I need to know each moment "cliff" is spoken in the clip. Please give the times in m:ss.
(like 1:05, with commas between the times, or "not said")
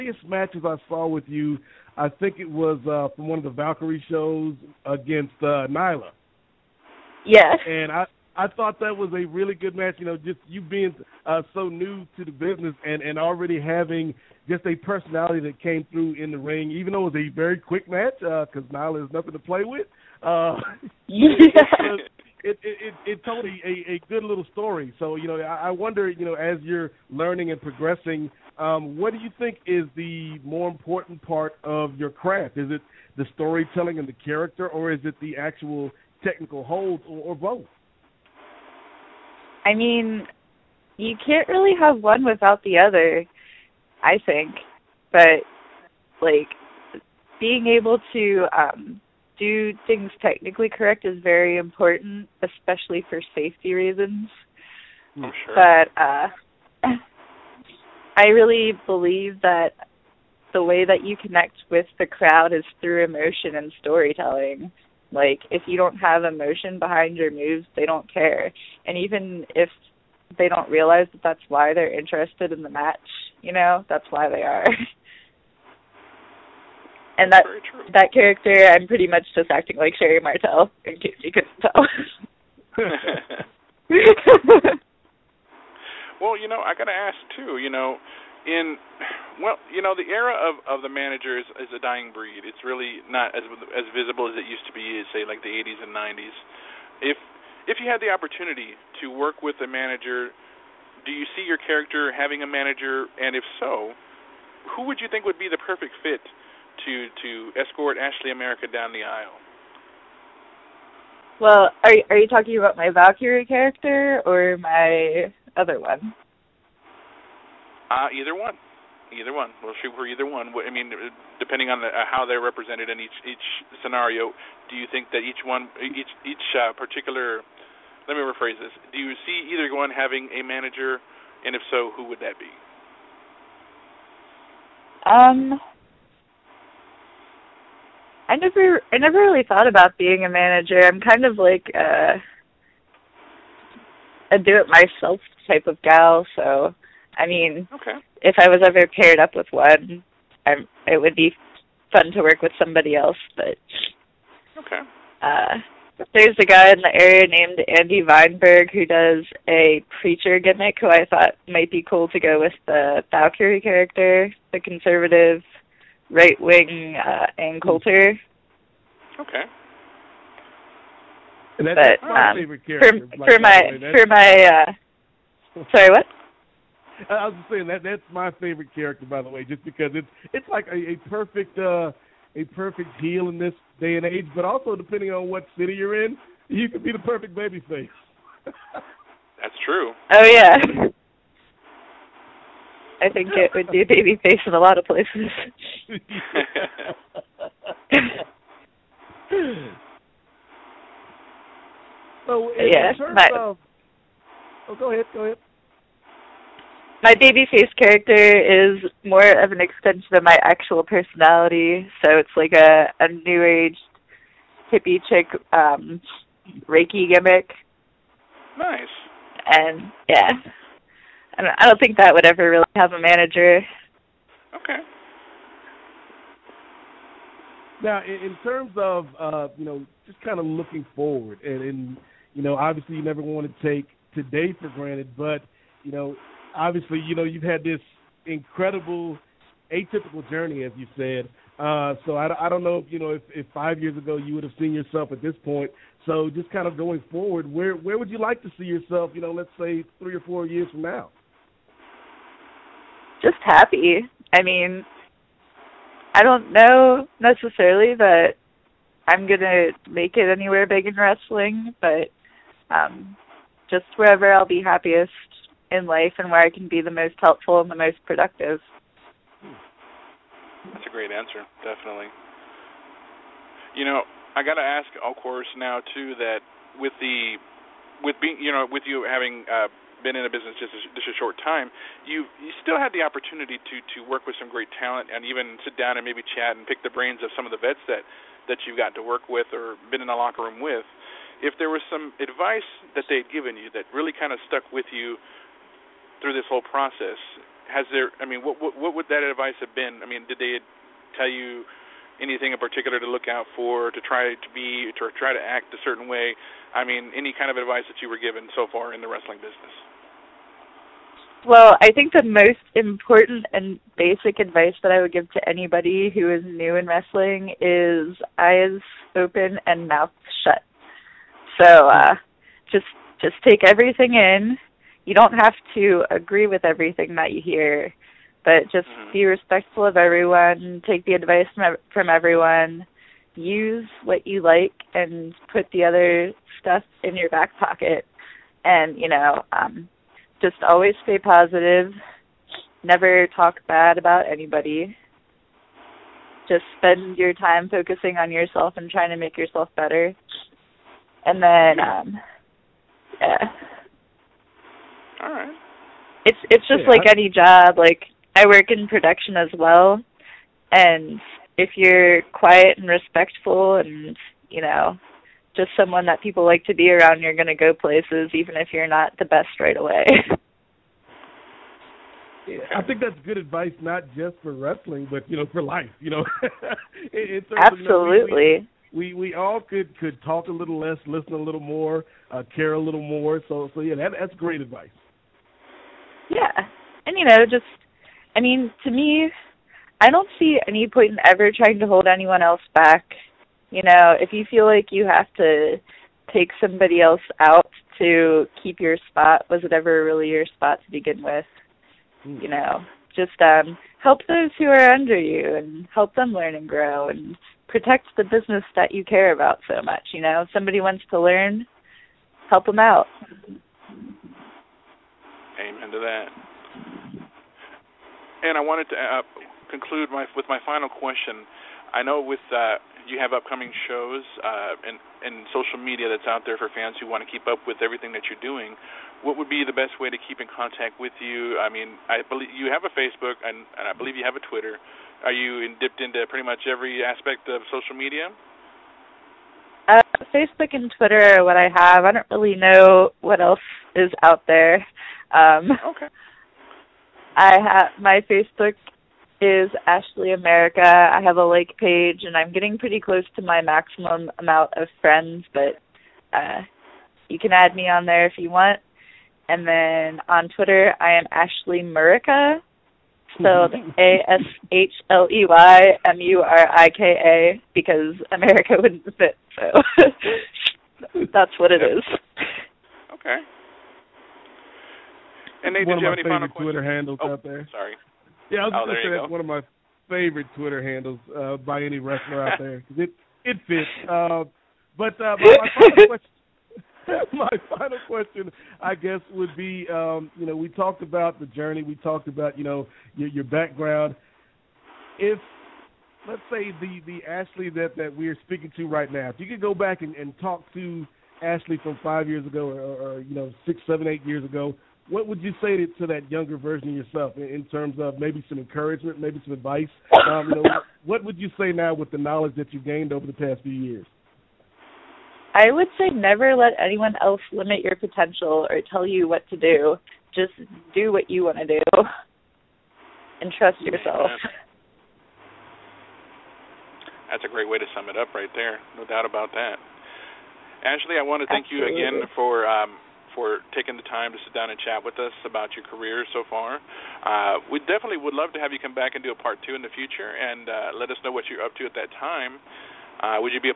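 not said.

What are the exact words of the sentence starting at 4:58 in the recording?
I mean, what, what, what would that advice have been?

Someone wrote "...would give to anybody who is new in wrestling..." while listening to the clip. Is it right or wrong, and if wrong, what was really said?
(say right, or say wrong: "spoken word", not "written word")
right.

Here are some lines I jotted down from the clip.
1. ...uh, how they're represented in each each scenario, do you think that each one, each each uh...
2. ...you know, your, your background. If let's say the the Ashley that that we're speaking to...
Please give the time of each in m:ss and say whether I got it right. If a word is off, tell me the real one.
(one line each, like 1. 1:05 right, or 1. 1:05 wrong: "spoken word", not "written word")
1. 2:01 right
2. 8:12 right.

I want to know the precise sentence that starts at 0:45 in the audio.
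But like being able to um do things technically correct is very important, especially for safety reasons.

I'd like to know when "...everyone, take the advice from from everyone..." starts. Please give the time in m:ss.
5:29.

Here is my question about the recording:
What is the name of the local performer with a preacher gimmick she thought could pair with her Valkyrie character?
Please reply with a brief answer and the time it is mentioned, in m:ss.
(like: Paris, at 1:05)
Andy Weinberg, at 2:37.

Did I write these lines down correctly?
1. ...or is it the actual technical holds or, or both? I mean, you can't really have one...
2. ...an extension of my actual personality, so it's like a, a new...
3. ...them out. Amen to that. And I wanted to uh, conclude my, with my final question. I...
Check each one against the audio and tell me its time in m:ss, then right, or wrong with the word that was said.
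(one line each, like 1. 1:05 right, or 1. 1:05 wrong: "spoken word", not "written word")
1. 0:34 right
2. 3:29 right
3. 6:52 right.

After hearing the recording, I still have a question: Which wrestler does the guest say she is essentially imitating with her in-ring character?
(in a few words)
Sherri Martel.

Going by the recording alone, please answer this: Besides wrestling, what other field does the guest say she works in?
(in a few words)
Production.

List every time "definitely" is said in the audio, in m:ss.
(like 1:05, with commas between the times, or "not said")
4:31, 8:57.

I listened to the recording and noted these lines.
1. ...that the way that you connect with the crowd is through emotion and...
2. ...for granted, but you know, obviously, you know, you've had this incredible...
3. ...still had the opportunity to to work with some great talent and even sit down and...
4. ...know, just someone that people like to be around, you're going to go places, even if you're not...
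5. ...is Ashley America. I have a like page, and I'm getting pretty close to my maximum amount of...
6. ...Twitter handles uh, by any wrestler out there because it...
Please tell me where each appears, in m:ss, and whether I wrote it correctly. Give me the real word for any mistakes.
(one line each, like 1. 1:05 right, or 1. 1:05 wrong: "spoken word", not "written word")
1. 0:59 right
2. 3:54 right
3. 4:42 right
4. 6:04 right
5. 7:29 right
6. 8:00 right.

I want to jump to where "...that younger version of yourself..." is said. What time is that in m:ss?
8:26.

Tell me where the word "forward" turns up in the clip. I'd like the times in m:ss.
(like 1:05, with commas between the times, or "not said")
3:50, 4:07.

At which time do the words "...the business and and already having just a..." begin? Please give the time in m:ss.
0:12.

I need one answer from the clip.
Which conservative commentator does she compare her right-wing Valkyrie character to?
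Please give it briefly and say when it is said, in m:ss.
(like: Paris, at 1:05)
Ann Coulter, at 2:47.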